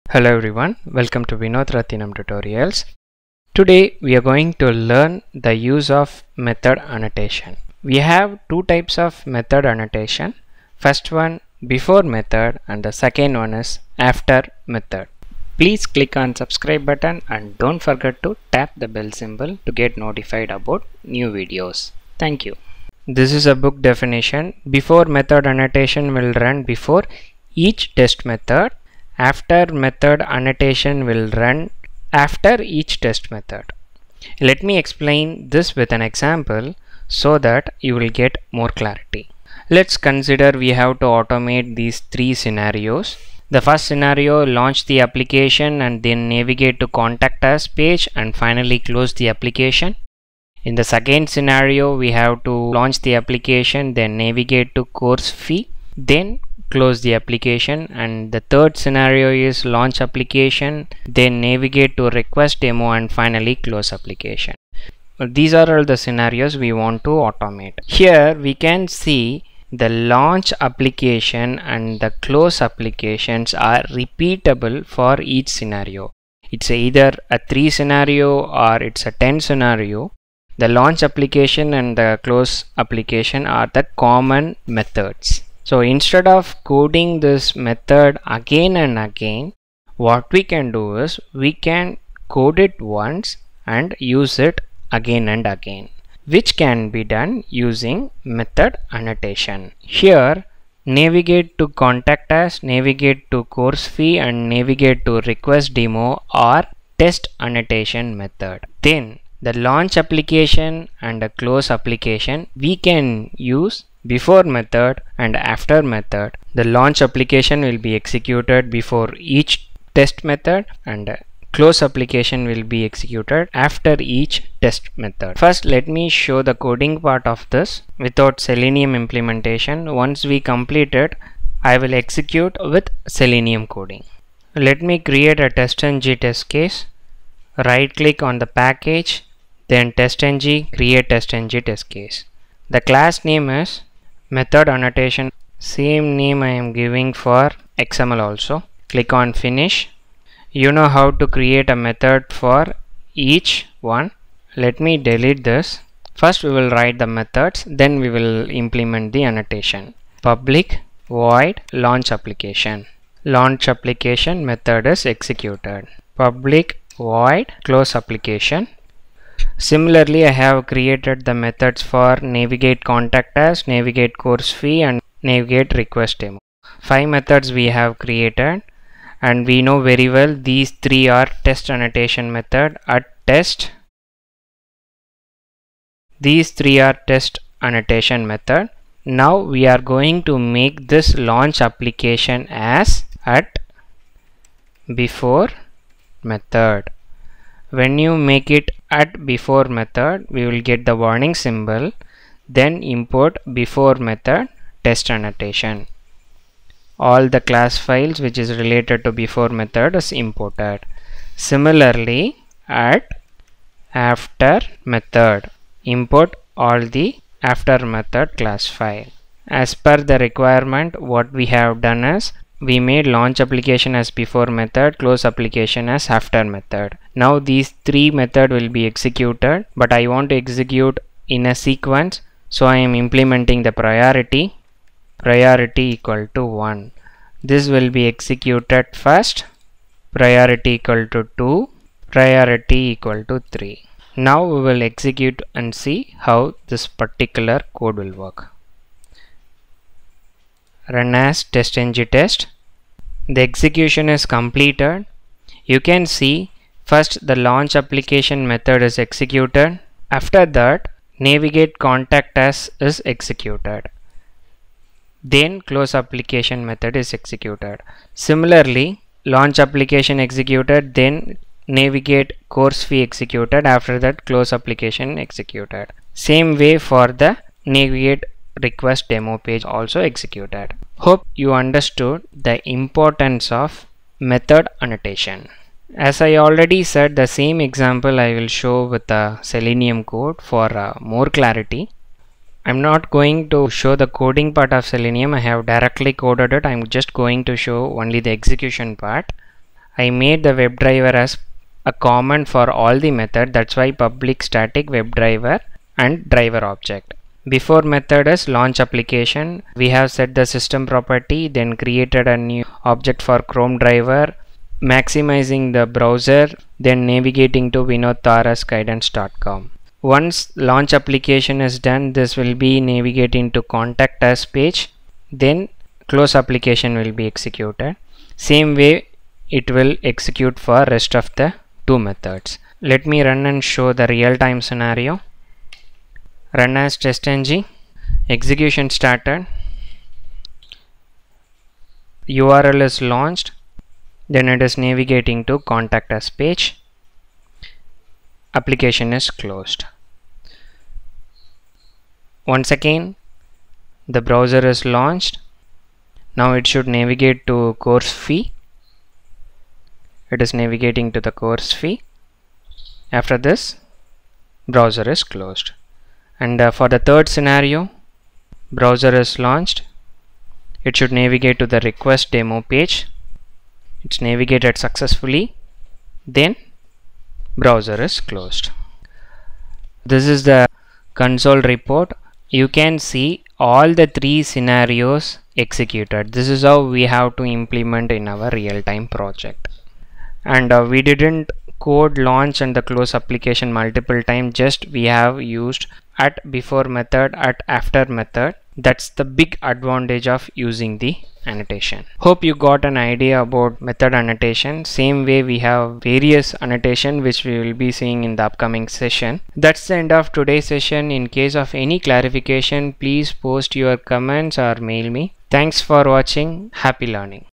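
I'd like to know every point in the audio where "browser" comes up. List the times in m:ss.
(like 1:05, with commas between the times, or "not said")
5:15, 5:54, 6:04, 6:08, 6:17.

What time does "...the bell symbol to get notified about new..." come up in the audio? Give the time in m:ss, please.
0:18.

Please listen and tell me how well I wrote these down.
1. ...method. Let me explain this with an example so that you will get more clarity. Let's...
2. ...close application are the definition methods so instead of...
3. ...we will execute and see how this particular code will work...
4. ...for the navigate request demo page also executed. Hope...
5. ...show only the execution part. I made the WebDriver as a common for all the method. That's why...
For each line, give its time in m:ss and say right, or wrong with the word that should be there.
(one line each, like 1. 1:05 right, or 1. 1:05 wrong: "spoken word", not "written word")
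1. 0:33 right
2. 1:22 wrong: "common", not "definition"
3. 4:04 right
4. 4:36 right
5. 4:57 right.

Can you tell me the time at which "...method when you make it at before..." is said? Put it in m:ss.
3:16.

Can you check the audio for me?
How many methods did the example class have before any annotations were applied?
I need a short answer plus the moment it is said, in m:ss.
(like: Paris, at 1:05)
Five, at 2:56.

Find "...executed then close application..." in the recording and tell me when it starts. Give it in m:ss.
4:23.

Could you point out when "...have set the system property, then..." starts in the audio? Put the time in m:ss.
5:09.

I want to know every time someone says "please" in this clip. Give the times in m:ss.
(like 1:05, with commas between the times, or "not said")
0:15, 6:53.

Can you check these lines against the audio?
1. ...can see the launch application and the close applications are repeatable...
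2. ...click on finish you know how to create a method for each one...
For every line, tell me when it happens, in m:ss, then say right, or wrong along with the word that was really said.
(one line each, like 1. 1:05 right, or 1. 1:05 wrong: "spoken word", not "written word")
1. 1:08 right
2. 2:28 right.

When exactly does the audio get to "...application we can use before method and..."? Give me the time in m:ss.
1:51.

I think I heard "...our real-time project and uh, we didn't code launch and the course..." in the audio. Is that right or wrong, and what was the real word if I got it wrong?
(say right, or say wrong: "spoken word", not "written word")
wrong: "close", not "course".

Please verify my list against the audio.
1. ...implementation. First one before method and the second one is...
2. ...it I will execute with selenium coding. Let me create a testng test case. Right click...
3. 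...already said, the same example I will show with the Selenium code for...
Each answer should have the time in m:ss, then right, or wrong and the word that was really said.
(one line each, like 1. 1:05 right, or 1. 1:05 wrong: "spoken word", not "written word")
1. 0:09 wrong: "annotation", not "implementation"
2. 2:10 right
3. 4:46 right.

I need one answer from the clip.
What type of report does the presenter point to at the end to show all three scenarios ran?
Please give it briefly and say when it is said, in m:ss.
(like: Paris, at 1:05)
Console report, at 6:21.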